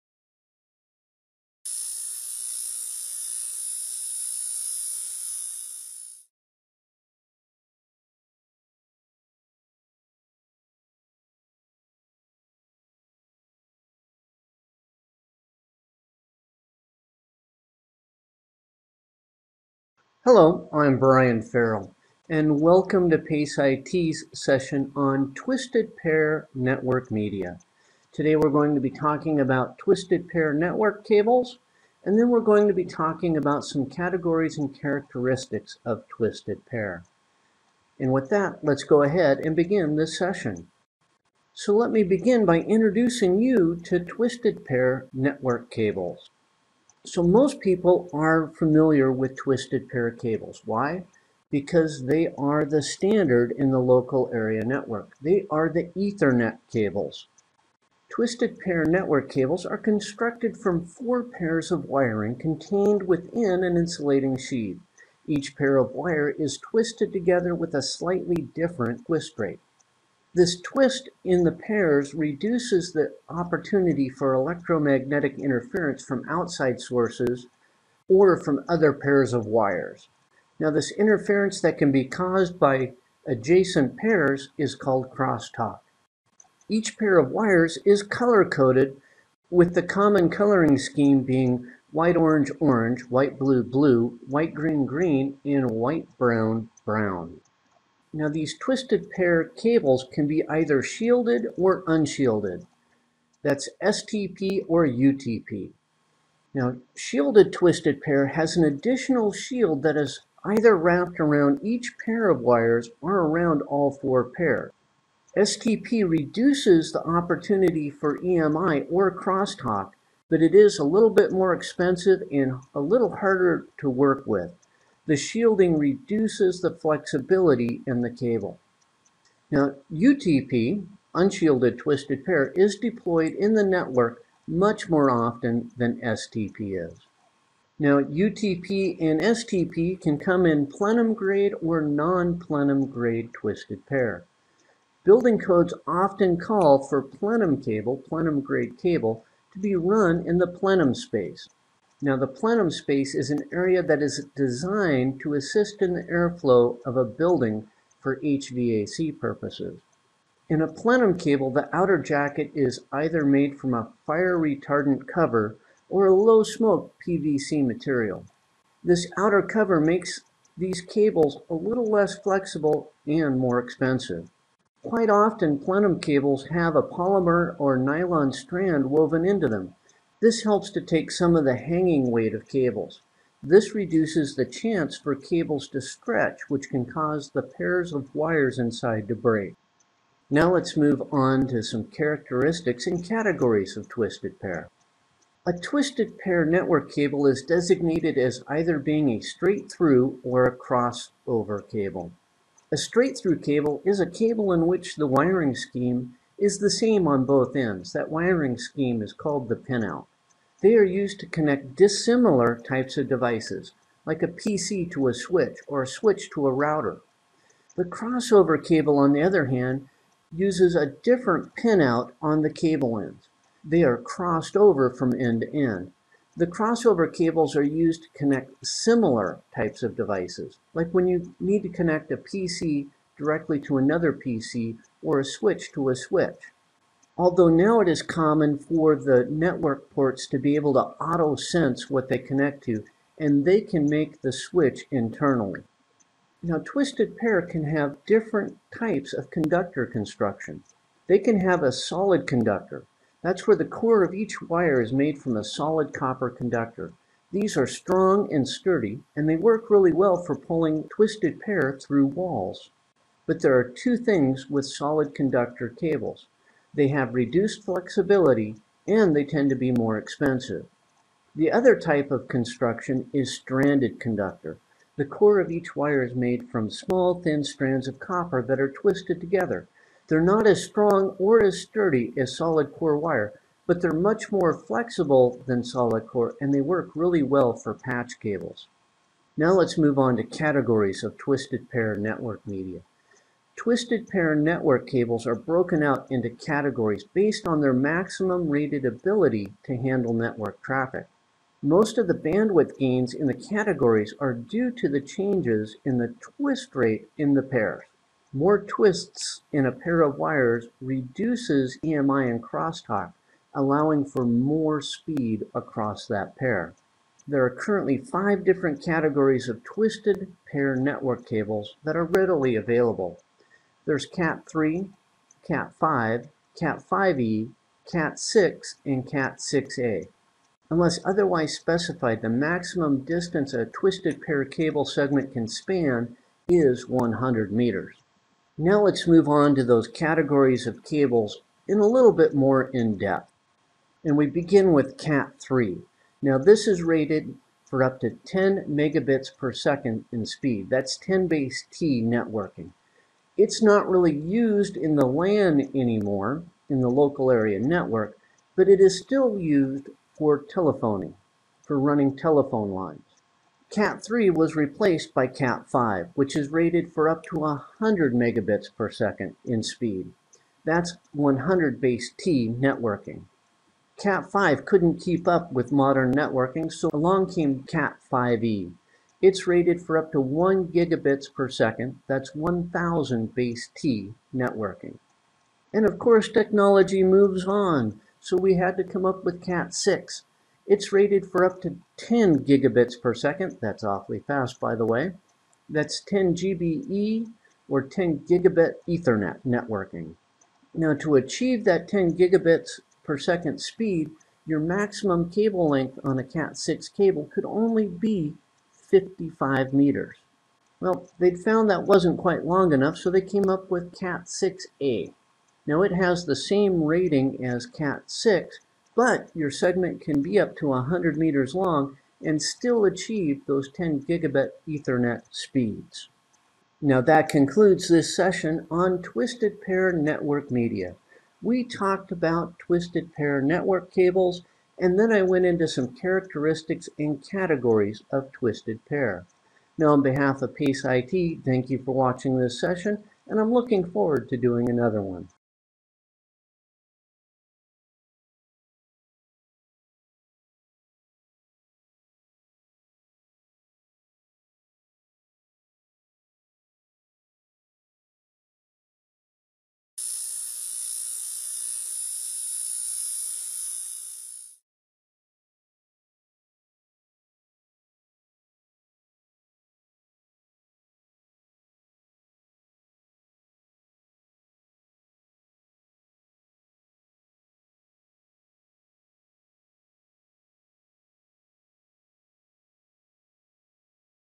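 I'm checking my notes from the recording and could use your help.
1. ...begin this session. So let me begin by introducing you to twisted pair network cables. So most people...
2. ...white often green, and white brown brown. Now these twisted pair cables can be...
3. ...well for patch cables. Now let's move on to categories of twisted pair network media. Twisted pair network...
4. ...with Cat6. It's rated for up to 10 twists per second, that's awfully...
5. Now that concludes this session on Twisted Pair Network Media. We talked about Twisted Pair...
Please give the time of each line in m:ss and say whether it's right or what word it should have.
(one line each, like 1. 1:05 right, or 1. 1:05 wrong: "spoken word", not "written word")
1. 0:39 right
2. 1:34 wrong: "green", not "often"
3. 4:47 right
4. 6:29 wrong: "gigabits", not "twists"
5. 7:06 right.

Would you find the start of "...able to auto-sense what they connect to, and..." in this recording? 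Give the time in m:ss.
4:00.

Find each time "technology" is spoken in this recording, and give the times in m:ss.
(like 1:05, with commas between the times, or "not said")
6:26.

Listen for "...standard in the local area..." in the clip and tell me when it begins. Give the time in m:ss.
0:52.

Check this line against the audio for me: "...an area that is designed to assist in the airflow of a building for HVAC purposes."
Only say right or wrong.
right.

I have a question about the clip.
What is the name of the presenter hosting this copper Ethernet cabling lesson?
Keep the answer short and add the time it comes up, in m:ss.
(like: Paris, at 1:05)
Brian Ferrill, at 0:20.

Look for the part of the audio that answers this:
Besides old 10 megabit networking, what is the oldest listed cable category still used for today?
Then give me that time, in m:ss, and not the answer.
6:02.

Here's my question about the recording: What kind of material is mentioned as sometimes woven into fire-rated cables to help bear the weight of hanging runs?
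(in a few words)
Polymer or nylon strand.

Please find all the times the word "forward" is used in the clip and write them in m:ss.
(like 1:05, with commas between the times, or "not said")
7:23.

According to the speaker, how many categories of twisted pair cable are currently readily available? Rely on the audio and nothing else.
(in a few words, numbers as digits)
5.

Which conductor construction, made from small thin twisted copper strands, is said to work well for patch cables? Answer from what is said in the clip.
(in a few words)
Stranded conductor.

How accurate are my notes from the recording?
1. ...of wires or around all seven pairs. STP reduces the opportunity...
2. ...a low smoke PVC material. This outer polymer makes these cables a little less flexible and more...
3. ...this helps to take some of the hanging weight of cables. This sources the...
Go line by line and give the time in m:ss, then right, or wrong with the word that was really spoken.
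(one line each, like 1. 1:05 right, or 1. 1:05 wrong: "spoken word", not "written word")
1. 1:52 wrong: "four", not "seven"
2. 2:46 wrong: "cover", not "polymer"
3. 3:00 wrong: "reduces", not "sources".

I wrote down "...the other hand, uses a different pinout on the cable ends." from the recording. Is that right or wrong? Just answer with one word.
right.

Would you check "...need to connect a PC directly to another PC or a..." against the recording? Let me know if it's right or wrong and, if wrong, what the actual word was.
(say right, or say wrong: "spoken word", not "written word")
right.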